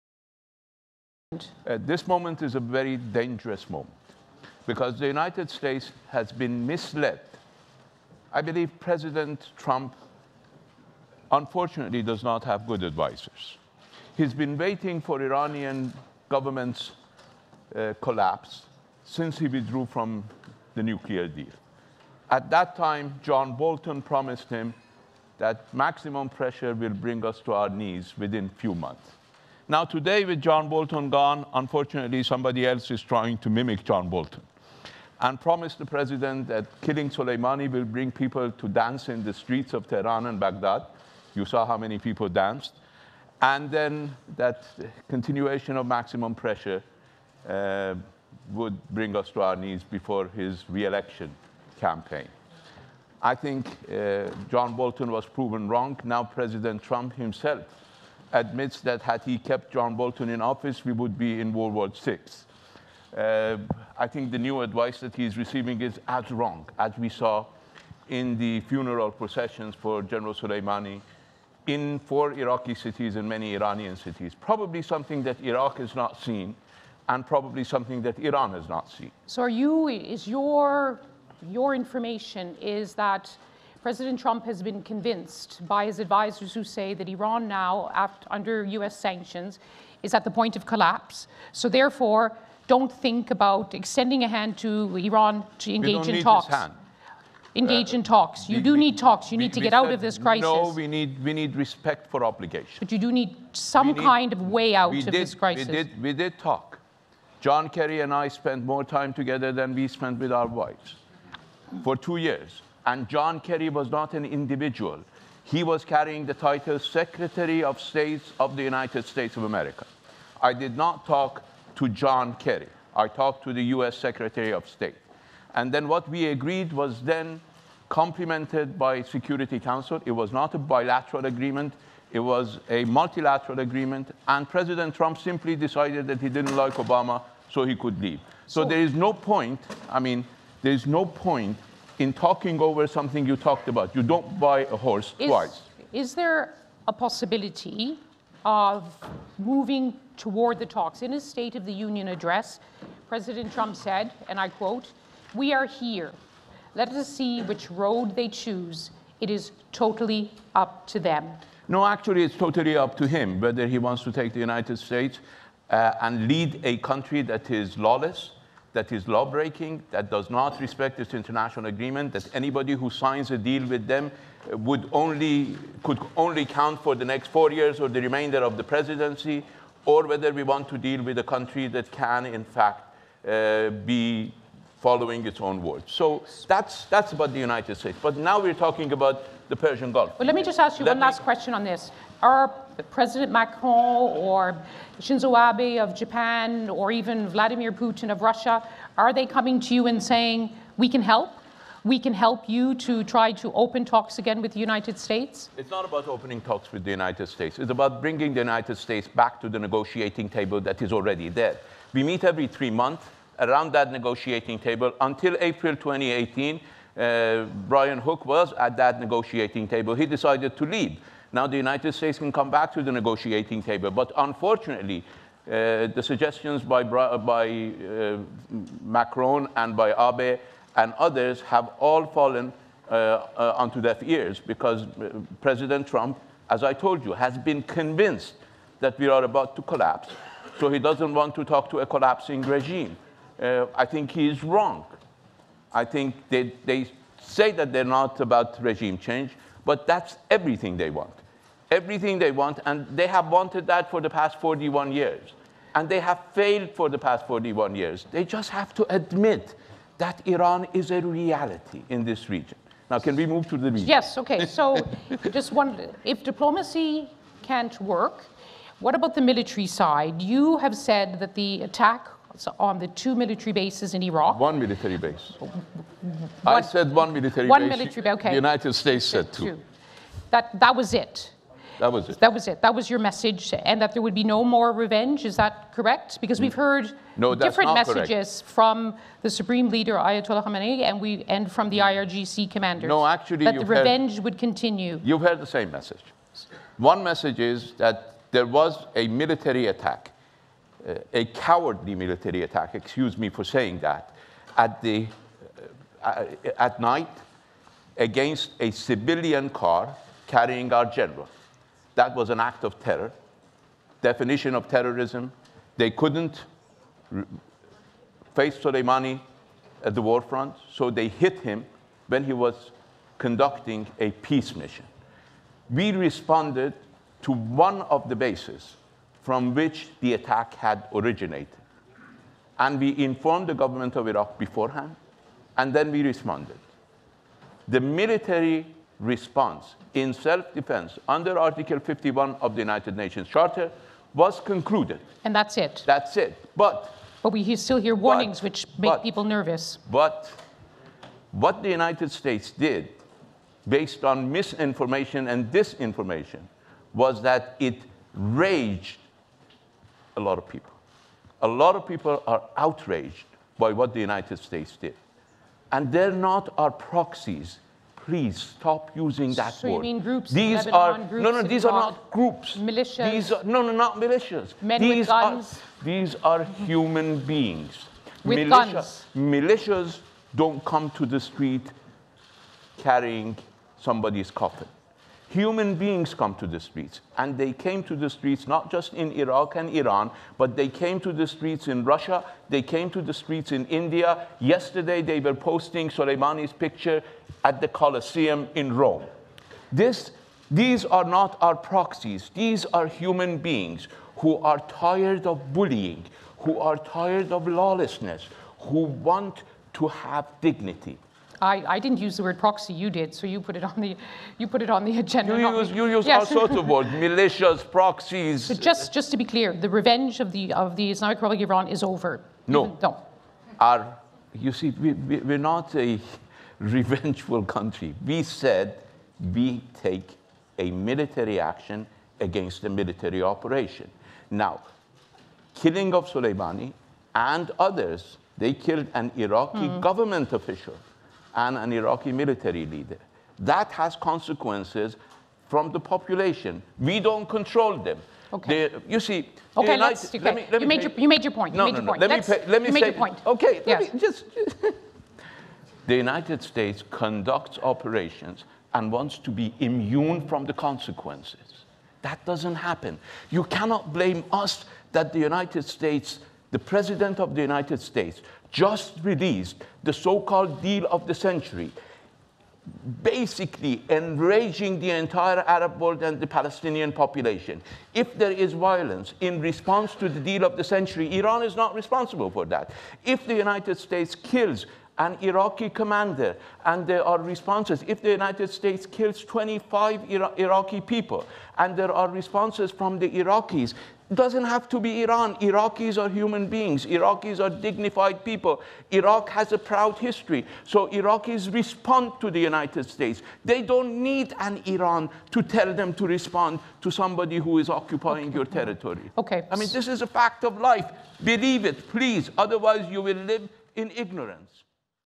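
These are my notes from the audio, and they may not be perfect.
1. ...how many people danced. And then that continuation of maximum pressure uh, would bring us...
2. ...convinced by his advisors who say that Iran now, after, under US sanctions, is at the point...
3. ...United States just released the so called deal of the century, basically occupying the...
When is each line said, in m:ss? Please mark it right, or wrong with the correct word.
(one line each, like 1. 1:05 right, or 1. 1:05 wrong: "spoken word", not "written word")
1. 0:41 right
2. 1:24 right
3. 7:47 wrong: "enraging", not "occupying".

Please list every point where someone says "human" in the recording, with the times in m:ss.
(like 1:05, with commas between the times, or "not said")
6:16, 6:25, 6:42, 8:16.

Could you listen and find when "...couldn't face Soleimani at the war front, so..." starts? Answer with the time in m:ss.
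5:15.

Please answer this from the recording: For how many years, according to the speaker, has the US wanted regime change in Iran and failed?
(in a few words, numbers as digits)
41.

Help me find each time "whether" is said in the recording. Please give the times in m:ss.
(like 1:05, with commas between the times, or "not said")
2:43, 3:00.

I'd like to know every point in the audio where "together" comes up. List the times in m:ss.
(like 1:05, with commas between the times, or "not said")
1:49.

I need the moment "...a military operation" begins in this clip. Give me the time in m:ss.
7:12.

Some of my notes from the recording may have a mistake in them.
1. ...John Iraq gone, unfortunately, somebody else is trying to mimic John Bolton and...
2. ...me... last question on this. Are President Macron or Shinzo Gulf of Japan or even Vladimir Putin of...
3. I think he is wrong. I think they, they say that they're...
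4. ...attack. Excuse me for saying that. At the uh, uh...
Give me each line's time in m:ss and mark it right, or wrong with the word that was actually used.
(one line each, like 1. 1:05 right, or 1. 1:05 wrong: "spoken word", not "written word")
1. 0:30 wrong: "Bolton", not "Iraq"
2. 3:10 wrong: "Abe", not "Gulf"
3. 4:03 right
4. 5:02 right.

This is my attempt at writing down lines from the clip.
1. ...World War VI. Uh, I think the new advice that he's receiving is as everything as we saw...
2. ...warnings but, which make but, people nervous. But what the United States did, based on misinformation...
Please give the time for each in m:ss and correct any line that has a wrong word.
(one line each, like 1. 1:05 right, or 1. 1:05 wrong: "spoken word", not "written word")
1. 1:01 wrong: "wrong", not "everything"
2. 5:47 right.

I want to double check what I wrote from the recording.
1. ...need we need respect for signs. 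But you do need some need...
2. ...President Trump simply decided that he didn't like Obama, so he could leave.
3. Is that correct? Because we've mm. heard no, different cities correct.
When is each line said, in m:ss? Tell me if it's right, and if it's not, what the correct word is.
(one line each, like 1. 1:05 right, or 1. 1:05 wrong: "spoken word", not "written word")
1. 1:40 wrong: "obligations", not "signs"
2. 2:14 right
3. 4:45 wrong: "messages", not "cities".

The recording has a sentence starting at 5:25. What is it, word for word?
We responded to one of the bases from which the attack had originated.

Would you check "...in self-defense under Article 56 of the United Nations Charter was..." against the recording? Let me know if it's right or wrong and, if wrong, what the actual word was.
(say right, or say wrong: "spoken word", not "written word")
wrong: "51", not "56".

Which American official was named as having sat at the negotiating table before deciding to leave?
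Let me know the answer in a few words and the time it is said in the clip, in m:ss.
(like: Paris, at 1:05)
Brian Hook, at 3:37.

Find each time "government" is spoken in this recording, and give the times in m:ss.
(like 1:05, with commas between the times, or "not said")
0:16, 5:33, 7:19.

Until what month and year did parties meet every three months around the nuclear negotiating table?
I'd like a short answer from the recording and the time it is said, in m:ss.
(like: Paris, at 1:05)
April 2018, at 3:35.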